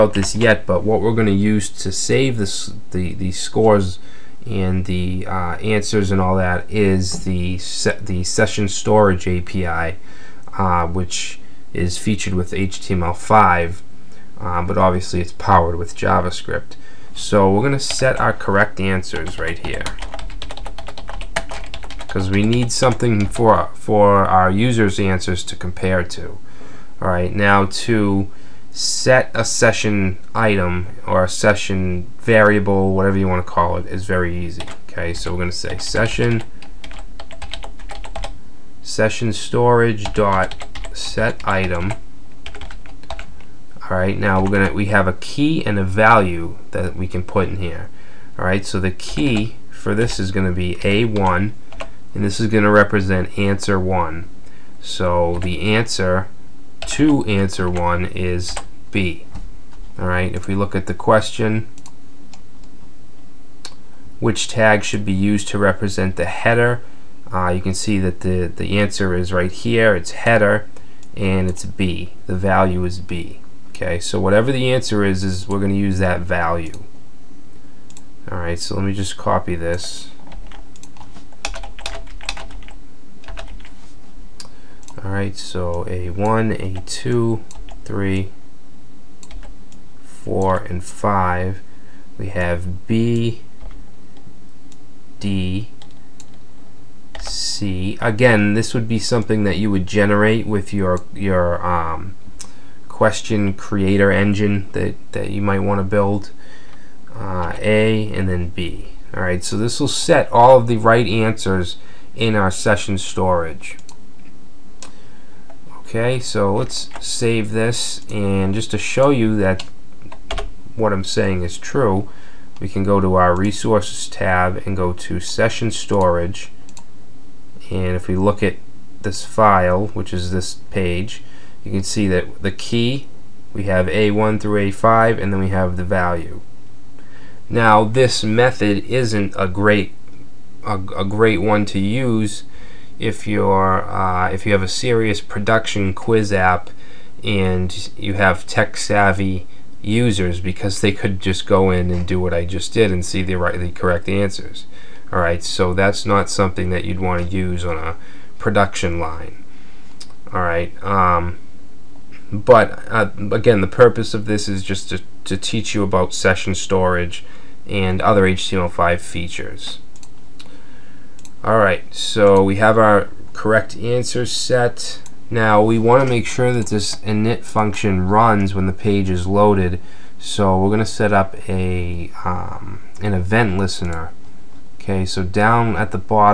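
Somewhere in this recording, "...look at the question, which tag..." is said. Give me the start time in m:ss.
1:00.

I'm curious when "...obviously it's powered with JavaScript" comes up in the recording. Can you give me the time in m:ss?
0:14.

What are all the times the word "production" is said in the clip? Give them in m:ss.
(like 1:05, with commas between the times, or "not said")
2:25, 2:38.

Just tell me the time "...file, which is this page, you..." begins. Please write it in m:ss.
2:09.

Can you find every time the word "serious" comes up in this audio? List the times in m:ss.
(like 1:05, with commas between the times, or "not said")
2:24.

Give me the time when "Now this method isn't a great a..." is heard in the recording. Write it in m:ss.
2:17.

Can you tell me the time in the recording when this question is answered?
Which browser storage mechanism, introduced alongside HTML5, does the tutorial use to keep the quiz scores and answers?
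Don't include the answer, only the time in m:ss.
0:08.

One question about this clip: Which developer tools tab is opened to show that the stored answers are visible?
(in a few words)
Resources.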